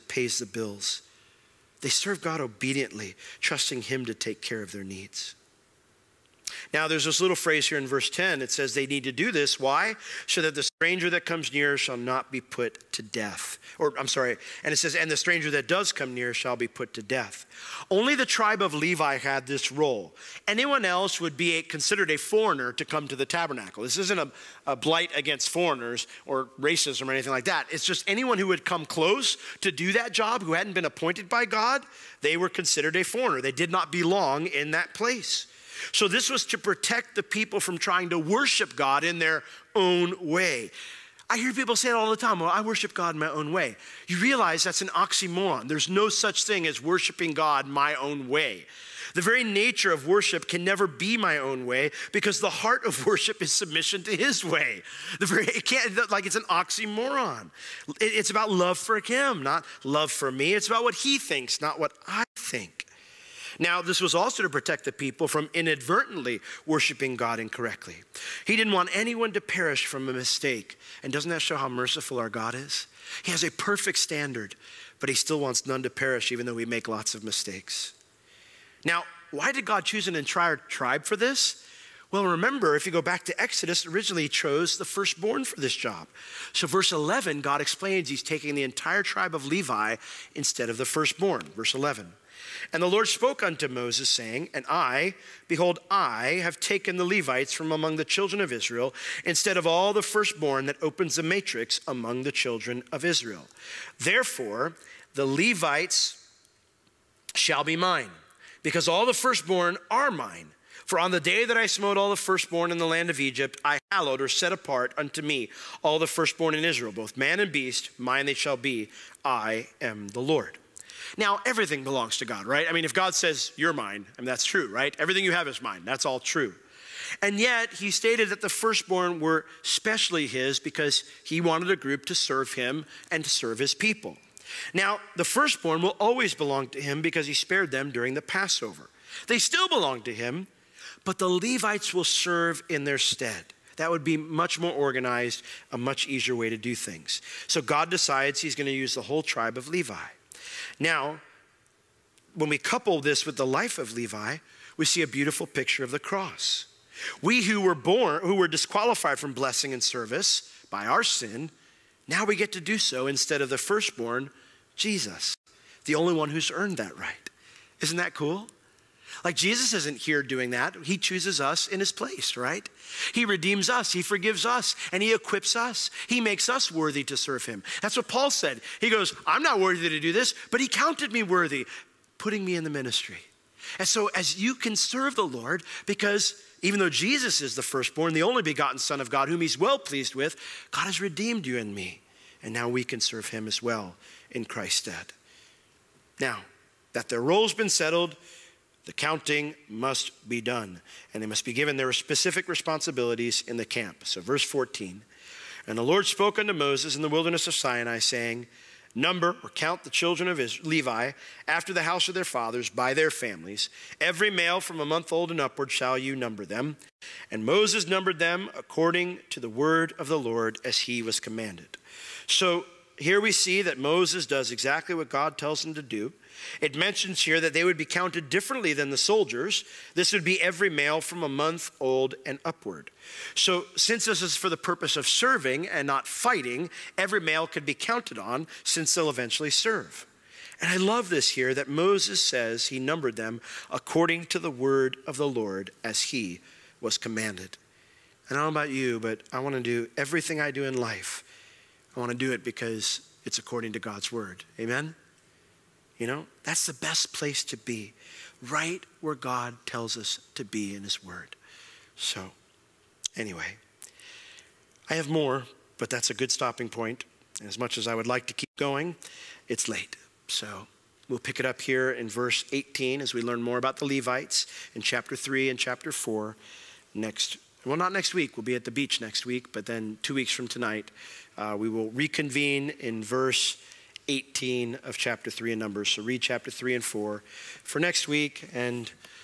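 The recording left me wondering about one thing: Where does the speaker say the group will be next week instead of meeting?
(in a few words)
The beach.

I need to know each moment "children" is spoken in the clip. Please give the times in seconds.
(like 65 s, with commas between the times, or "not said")
98 s, 102 s, 209 s.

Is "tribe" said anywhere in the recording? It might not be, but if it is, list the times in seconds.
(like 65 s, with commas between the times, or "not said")
18 s, 80 s, 89 s, 149 s.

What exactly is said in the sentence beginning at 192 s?
And now we can serve him as well in Christ's stead.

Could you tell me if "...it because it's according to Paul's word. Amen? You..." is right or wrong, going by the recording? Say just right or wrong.
wrong.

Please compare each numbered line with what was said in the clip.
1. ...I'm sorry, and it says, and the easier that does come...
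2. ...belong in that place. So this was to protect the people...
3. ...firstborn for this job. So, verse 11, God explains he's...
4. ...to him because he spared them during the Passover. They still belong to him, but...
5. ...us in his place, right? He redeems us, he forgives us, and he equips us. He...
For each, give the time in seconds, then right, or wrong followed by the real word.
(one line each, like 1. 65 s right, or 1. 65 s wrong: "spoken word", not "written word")
1. 13 s wrong: "stranger", not "easier"
2. 33 s right
3. 84 s right
4. 136 s right
5. 171 s right.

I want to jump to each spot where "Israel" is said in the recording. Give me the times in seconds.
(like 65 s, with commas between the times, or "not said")
98 s, 103 s, 116 s, 210 s.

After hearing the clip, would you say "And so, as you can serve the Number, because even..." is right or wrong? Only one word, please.
wrong.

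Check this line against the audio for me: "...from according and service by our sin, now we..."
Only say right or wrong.
wrong.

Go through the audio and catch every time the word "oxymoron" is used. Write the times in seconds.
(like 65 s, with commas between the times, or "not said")
44 s, 56 s.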